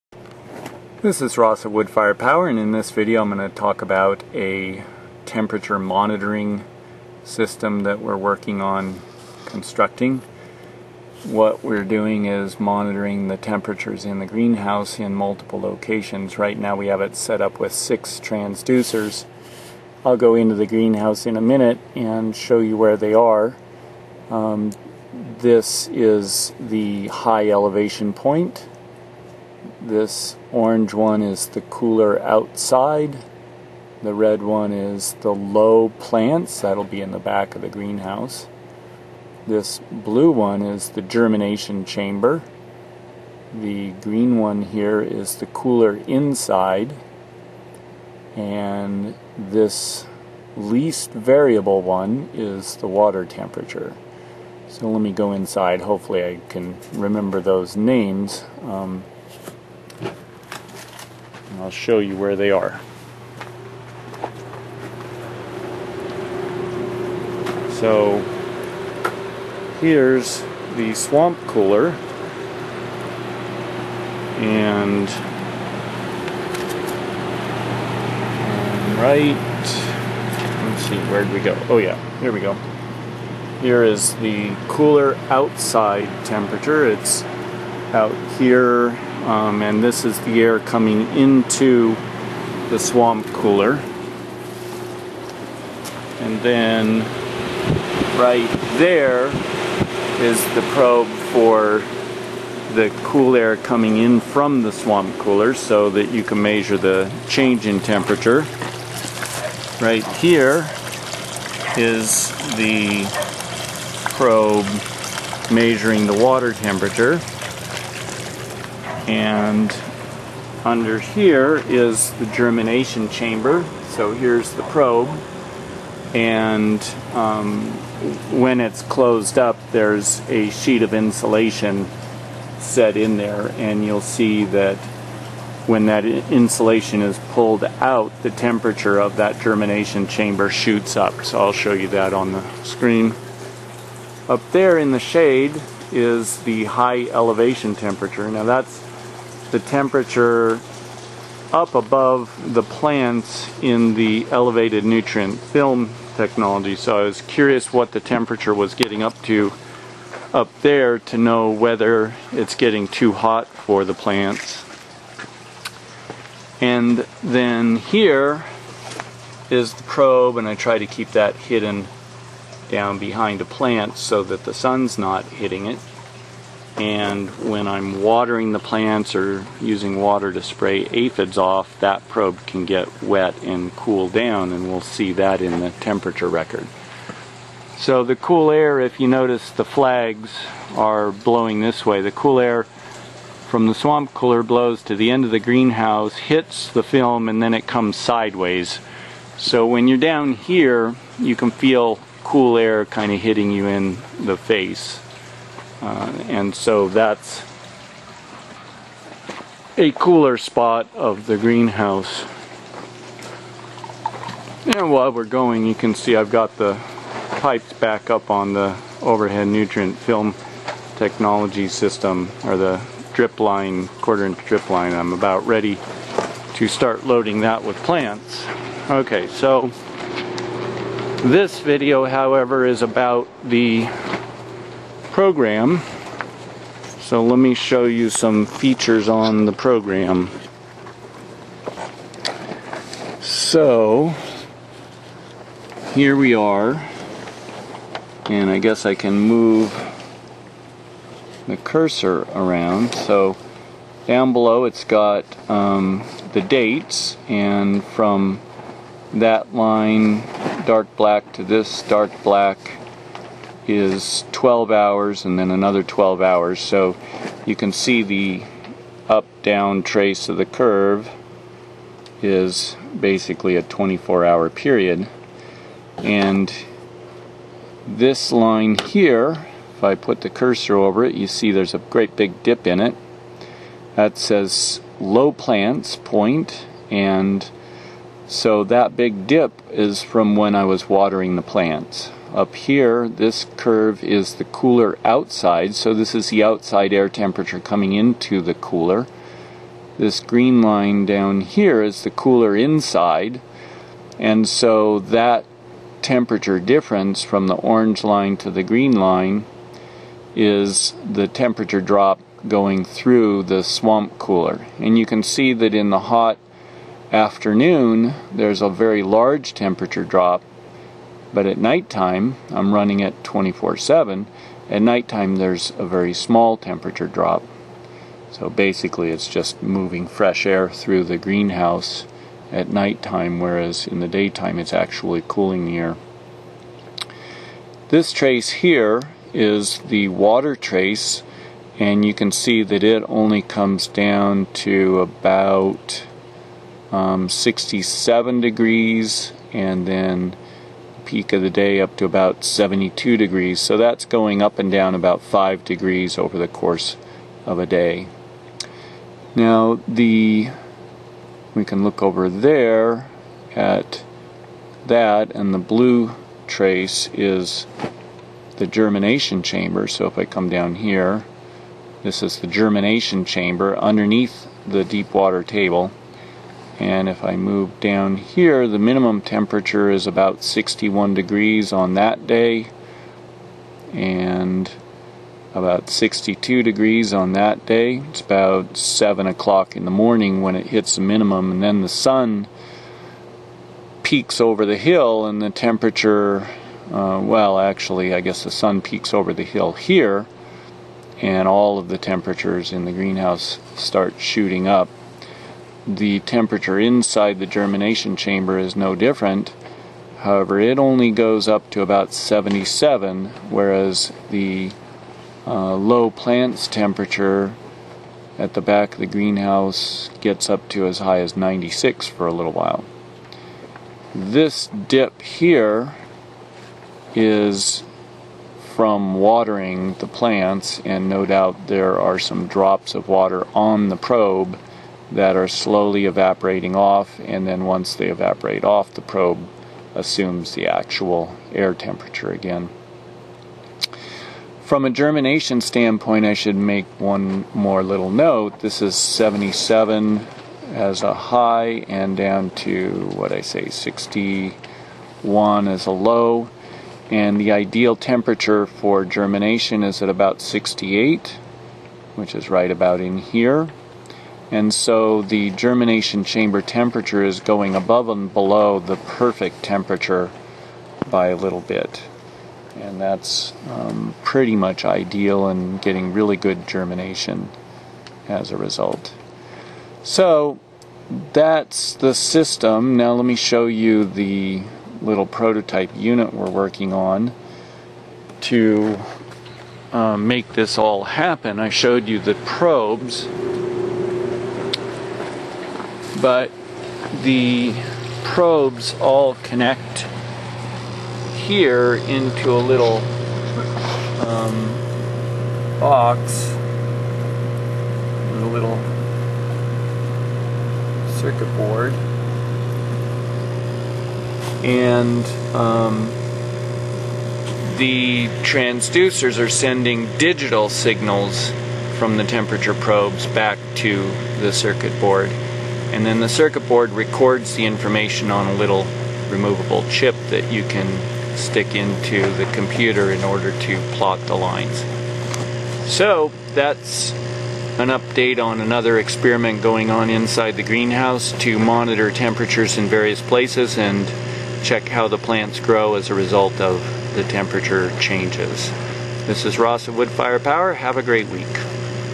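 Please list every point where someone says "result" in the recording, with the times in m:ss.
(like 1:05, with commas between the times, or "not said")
7:58, 9:06.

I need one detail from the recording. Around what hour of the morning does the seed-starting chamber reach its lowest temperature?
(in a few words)
7 o'clock.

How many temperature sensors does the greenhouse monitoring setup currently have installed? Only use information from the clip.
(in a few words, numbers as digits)
6.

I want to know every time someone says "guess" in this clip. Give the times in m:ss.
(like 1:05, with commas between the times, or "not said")
4:08, 6:38.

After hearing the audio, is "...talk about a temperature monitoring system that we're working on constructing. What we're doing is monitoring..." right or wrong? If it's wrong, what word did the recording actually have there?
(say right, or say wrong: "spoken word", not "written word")
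right.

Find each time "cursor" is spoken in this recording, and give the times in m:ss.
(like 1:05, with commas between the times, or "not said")
4:11, 4:40.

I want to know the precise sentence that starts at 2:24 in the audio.
Up there in the shade is the high elevation temperature.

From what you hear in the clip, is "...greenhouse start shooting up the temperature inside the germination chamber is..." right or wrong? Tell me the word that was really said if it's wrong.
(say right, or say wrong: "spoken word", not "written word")
right.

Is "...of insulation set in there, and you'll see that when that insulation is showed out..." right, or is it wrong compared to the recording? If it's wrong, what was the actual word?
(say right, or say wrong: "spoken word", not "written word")
wrong: "pulled", not "showed".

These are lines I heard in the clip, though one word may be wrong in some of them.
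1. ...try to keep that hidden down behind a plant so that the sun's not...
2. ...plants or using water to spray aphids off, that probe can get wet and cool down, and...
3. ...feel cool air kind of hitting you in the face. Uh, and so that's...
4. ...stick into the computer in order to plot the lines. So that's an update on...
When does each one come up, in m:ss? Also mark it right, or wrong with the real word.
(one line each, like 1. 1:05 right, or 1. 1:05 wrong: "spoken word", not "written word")
1. 2:50 right
2. 2:58 right
3. 3:21 right
4. 8:51 right.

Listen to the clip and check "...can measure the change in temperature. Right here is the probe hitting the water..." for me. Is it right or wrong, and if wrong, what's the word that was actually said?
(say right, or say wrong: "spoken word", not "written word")
wrong: "measuring", not "hitting".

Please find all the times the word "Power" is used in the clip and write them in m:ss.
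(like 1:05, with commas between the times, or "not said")
0:02, 9:10.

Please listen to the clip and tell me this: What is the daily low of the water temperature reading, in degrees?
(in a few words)
67.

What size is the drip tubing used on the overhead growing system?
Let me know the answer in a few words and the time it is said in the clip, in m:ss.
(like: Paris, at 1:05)
Quarter inch, at 3:43.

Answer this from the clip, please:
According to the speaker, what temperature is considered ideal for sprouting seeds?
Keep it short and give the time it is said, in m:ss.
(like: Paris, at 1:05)
68, at 7:40.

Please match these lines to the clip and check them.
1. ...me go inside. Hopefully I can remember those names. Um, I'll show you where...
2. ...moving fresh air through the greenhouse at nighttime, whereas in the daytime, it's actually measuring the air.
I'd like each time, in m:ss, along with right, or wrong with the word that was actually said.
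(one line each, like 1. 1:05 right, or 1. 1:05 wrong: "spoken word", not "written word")
1. 0:55 right
2. 5:29 wrong: "cooling", not "measuring".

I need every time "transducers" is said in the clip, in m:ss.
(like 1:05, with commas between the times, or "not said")
0:18, 8:38.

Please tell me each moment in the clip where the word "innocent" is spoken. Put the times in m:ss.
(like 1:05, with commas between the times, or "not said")
not said.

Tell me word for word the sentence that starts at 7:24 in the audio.
From a germination standpoint, I should make one more little note.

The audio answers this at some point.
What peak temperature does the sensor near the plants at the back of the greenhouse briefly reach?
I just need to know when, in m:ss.
7:01.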